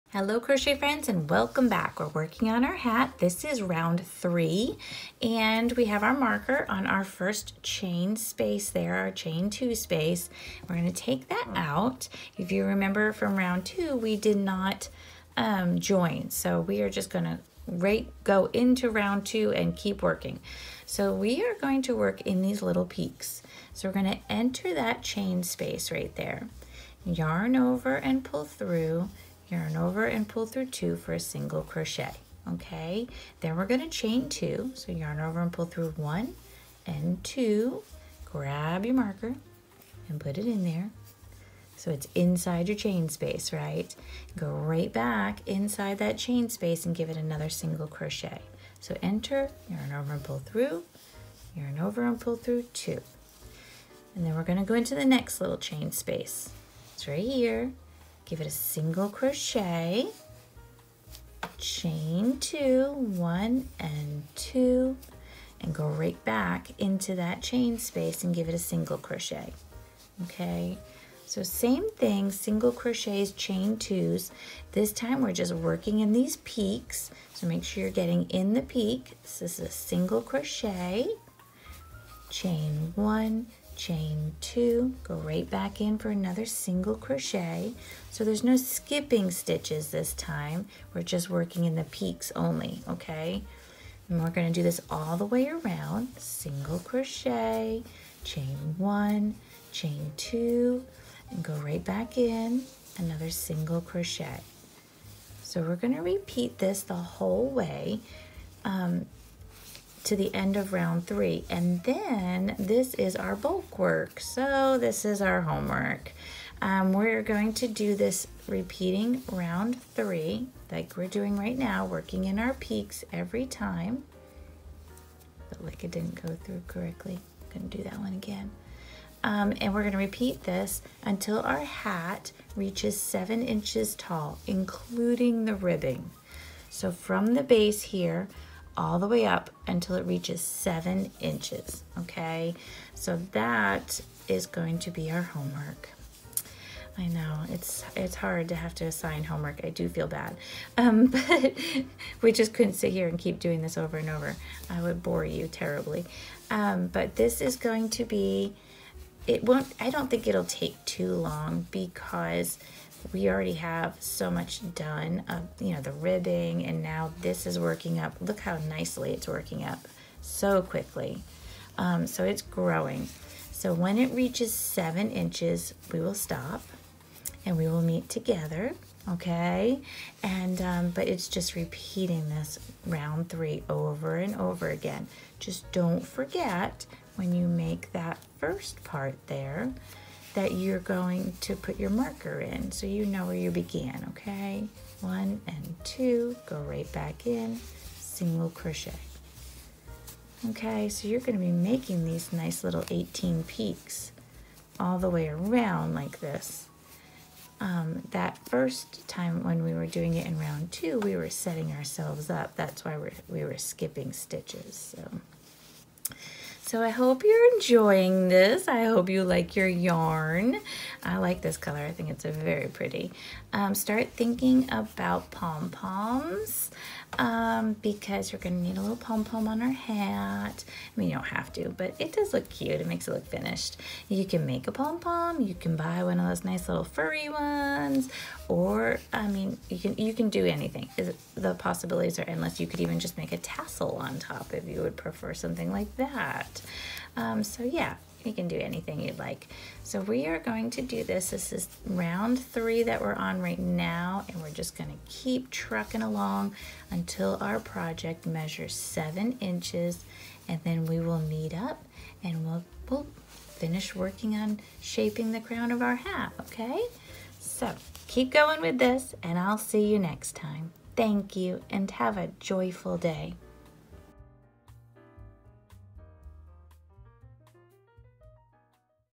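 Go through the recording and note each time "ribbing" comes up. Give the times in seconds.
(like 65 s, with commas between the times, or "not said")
135 s, 165 s.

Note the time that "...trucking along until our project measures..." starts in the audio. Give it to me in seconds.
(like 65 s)
255 s.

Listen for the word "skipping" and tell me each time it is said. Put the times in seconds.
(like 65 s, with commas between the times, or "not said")
88 s, 213 s.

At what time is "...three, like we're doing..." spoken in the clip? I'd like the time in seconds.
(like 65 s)
119 s.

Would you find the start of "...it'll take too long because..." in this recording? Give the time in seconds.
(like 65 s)
160 s.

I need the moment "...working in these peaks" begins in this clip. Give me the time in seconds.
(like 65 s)
75 s.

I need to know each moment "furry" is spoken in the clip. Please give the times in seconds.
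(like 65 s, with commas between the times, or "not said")
236 s.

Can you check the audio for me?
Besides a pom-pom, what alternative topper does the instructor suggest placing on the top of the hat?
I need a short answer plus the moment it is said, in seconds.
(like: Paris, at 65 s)
A tassel, at 243 s.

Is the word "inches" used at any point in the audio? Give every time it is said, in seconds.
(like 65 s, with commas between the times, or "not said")
133 s, 141 s, 175 s, 259 s.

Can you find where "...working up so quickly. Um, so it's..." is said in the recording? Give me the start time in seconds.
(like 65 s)
169 s.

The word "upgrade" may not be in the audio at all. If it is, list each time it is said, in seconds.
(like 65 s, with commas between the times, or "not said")
not said.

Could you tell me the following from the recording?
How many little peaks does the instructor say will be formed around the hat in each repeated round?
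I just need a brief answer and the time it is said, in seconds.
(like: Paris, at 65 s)
18, at 202 s.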